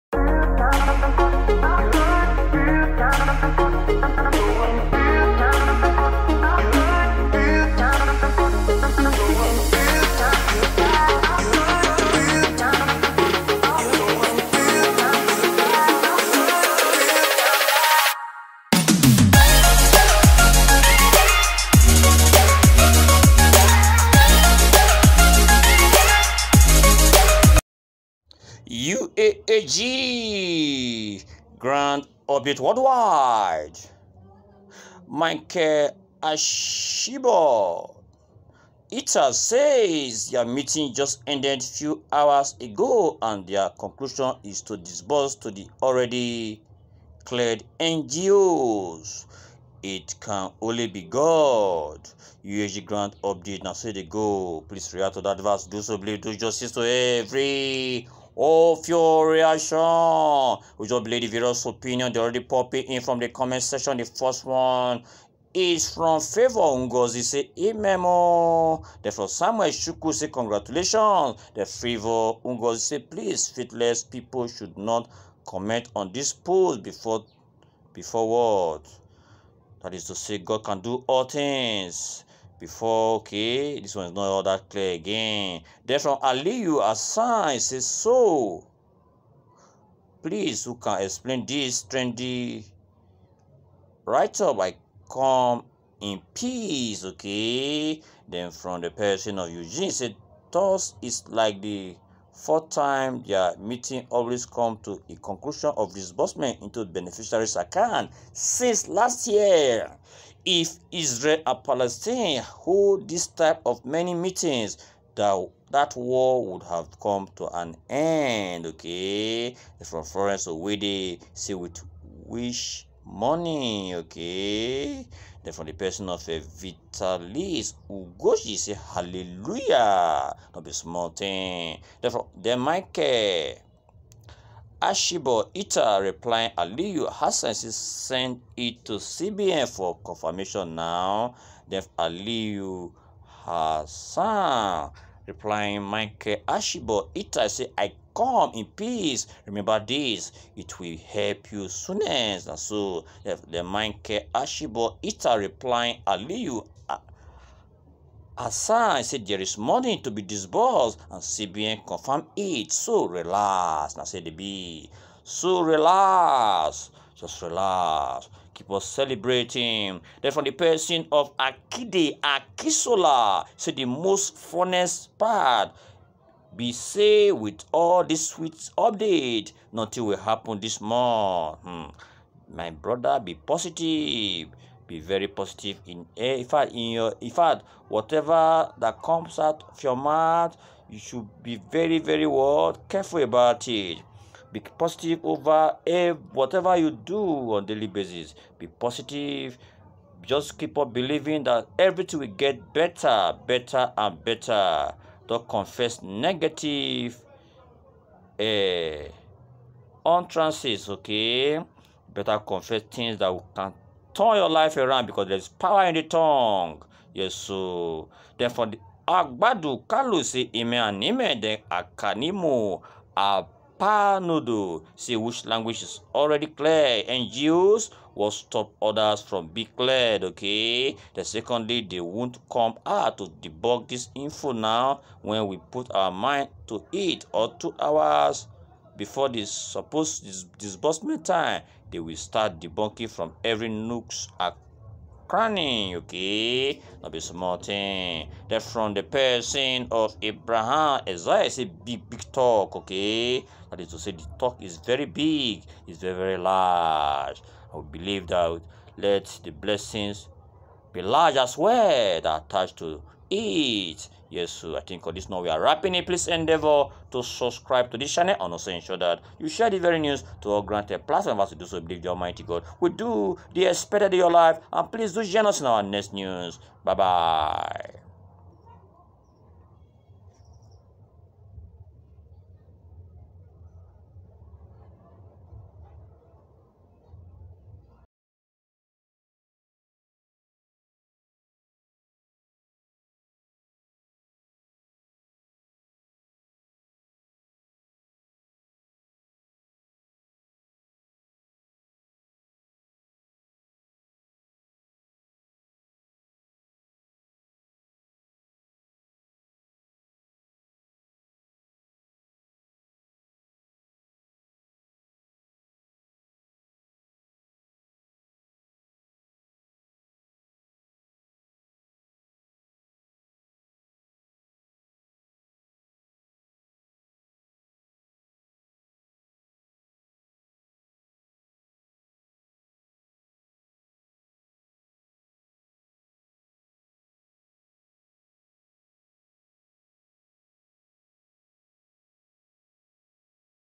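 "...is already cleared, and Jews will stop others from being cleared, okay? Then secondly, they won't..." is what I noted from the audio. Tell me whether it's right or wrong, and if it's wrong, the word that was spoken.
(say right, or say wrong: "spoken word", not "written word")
right.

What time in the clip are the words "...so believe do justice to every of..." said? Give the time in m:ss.
0:55.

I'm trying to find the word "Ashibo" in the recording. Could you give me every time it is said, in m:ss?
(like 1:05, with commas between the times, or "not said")
0:36, 2:14, 2:26, 2:34.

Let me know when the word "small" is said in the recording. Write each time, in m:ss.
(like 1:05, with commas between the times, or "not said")
2:10, 4:07.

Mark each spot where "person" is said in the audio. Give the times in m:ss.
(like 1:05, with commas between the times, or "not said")
1:38, 2:05, 2:50, 4:09.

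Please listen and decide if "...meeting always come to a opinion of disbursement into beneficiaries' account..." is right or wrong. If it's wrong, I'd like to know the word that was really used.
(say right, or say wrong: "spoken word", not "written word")
wrong: "conclusion", not "opinion".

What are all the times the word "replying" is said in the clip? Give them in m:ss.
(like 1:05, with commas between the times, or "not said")
2:16, 2:25, 2:35.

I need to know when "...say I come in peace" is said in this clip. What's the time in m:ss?
2:27.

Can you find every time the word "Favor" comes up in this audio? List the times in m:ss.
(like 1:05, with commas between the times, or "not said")
1:06, 1:11.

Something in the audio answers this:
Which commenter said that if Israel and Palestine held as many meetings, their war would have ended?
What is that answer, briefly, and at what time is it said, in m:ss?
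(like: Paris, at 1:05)
Eugene, at 1:39.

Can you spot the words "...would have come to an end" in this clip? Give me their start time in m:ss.
1:56.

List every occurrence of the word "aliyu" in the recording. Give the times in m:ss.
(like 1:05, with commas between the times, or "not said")
1:26, 2:16, 2:21, 2:36.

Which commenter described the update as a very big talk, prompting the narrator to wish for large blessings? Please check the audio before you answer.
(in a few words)
Abraham Isaiah.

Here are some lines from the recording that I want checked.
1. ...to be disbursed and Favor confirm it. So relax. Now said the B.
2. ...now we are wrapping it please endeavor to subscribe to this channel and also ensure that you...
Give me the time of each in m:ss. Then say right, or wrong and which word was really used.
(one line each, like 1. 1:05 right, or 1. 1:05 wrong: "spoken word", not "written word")
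1. 2:39 wrong: "CBN", not "Favor"
2. 4:25 right.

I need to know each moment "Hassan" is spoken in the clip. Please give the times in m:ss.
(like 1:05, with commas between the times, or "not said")
1:26, 2:17, 2:23, 2:38.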